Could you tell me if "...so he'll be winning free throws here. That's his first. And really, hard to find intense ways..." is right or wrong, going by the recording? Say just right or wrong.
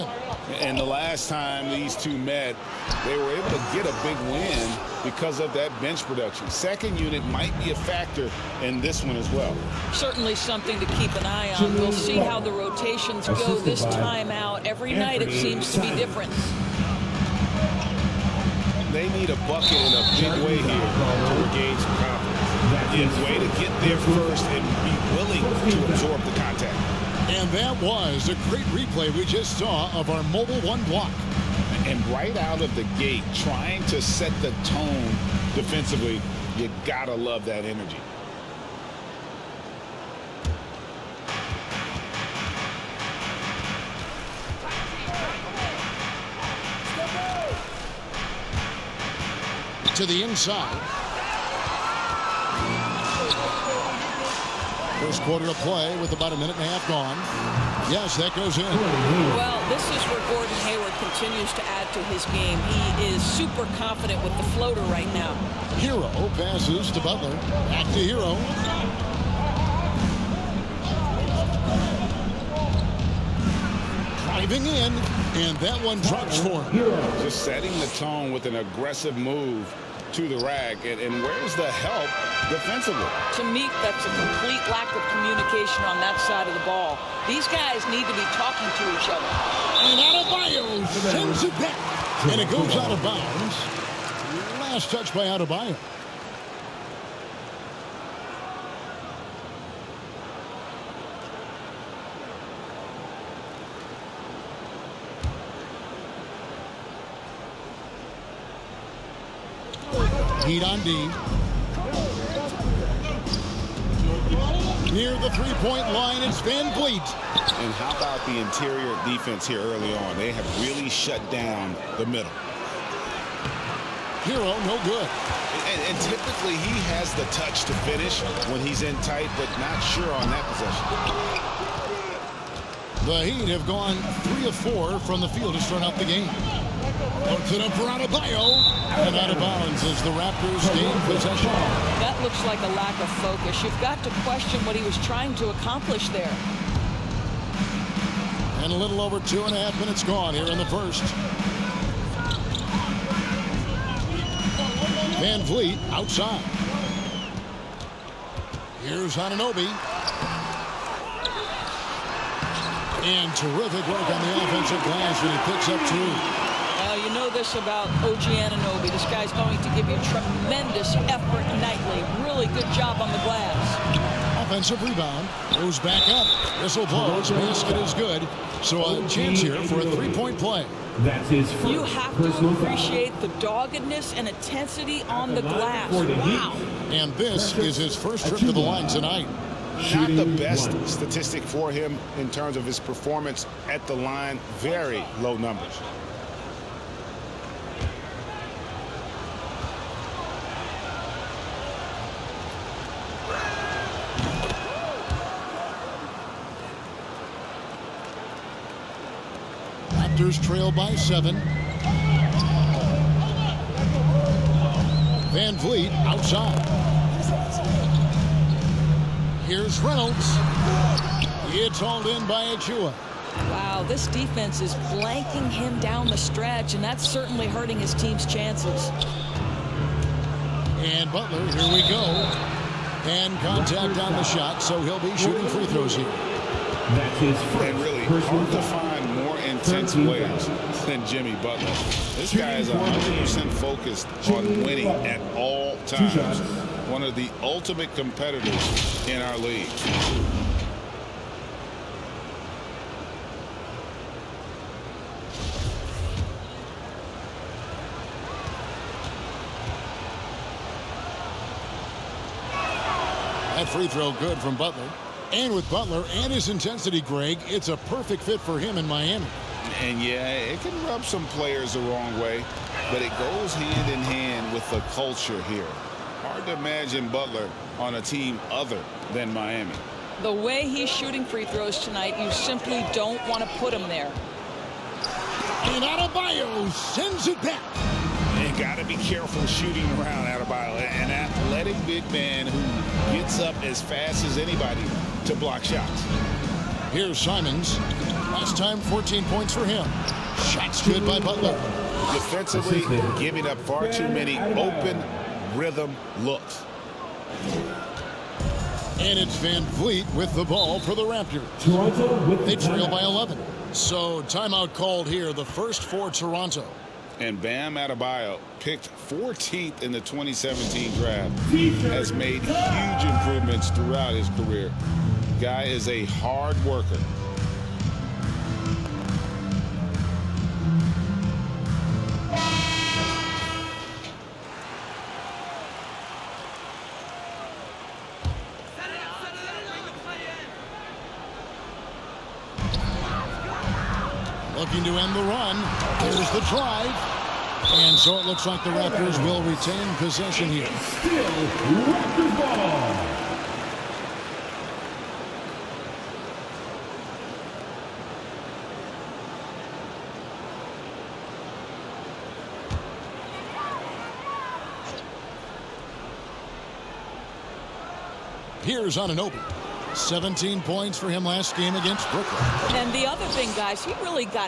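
wrong.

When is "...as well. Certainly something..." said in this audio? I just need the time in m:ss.
0:09.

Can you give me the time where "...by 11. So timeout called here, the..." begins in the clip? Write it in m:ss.
5:12.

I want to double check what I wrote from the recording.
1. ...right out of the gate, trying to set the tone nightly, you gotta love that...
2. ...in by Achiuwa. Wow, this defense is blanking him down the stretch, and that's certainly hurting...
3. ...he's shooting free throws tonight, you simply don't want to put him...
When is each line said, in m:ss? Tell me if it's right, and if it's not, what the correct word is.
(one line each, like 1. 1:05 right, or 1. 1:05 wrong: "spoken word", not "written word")
1. 0:32 wrong: "defensively", not "nightly"
2. 3:42 right
3. 4:40 right.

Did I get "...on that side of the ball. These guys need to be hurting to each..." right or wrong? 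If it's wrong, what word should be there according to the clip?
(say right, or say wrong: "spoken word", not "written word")
wrong: "talking", not "hurting".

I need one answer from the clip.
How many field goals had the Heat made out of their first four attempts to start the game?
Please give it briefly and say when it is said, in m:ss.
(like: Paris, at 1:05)
3, at 2:14.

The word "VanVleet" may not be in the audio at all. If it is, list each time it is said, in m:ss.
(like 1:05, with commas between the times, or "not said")
1:56, 2:35, 3:35, 5:09.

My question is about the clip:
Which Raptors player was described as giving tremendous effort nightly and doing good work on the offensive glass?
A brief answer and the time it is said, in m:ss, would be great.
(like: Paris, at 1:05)
OG Anunoby, at 2:48.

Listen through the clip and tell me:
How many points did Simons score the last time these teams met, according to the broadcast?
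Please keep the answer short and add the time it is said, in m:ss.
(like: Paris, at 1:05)
14, at 4:58.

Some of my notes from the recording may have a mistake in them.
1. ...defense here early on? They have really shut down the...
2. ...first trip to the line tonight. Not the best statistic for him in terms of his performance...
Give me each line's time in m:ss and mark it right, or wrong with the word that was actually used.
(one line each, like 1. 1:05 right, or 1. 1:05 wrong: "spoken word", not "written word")
1. 1:59 right
2. 3:07 right.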